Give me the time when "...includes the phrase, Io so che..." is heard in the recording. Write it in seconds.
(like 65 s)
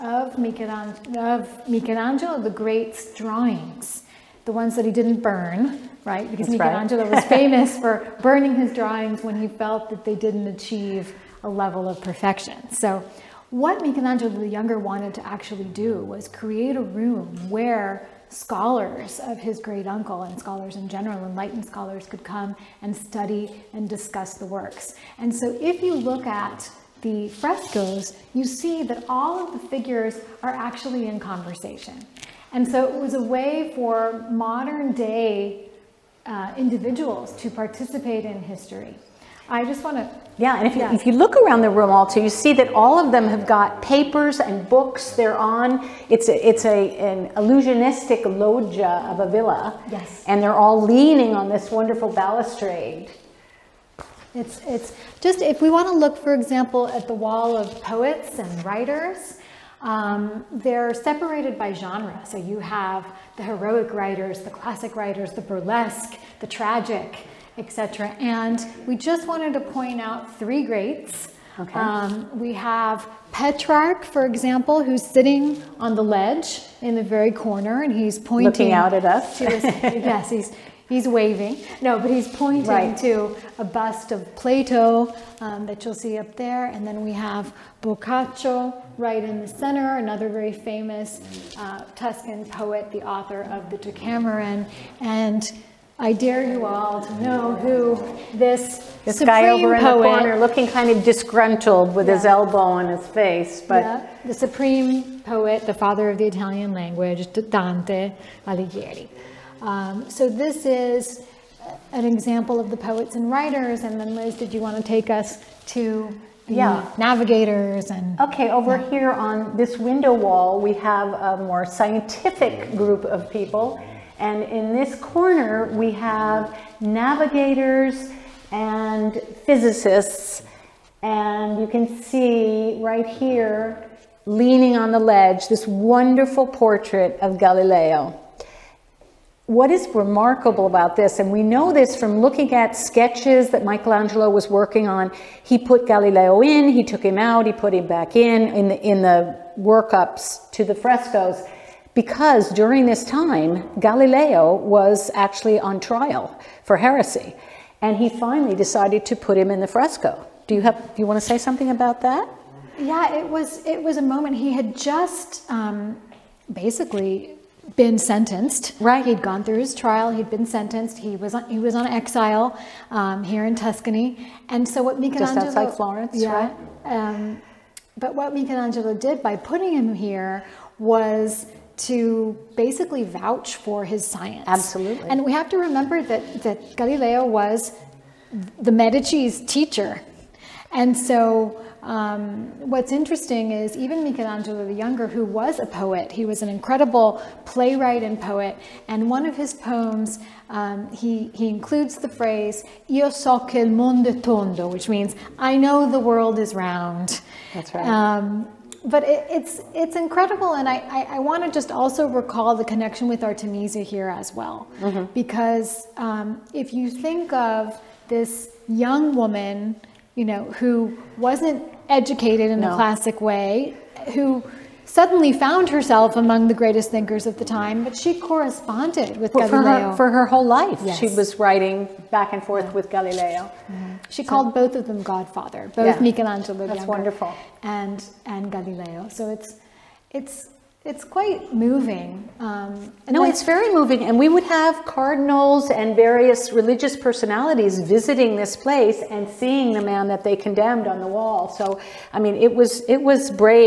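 201 s.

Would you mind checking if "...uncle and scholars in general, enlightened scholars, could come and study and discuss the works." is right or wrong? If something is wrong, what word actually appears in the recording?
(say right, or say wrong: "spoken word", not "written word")
right.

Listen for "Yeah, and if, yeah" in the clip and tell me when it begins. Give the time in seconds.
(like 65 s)
40 s.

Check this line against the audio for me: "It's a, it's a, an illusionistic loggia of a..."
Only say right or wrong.
right.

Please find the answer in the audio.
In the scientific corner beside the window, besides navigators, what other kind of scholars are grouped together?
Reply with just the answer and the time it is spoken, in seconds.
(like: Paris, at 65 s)
physicists, at 129 s.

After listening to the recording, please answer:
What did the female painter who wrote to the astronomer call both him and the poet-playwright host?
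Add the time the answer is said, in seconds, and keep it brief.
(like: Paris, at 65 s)
Godfather, at 235 s.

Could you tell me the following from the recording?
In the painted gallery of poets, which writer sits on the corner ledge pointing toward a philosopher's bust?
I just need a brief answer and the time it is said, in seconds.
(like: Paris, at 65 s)
Petrarch, at 73 s.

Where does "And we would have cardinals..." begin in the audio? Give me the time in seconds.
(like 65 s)
244 s.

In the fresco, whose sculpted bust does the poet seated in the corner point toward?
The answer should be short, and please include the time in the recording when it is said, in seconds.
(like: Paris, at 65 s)
Plato, at 84 s.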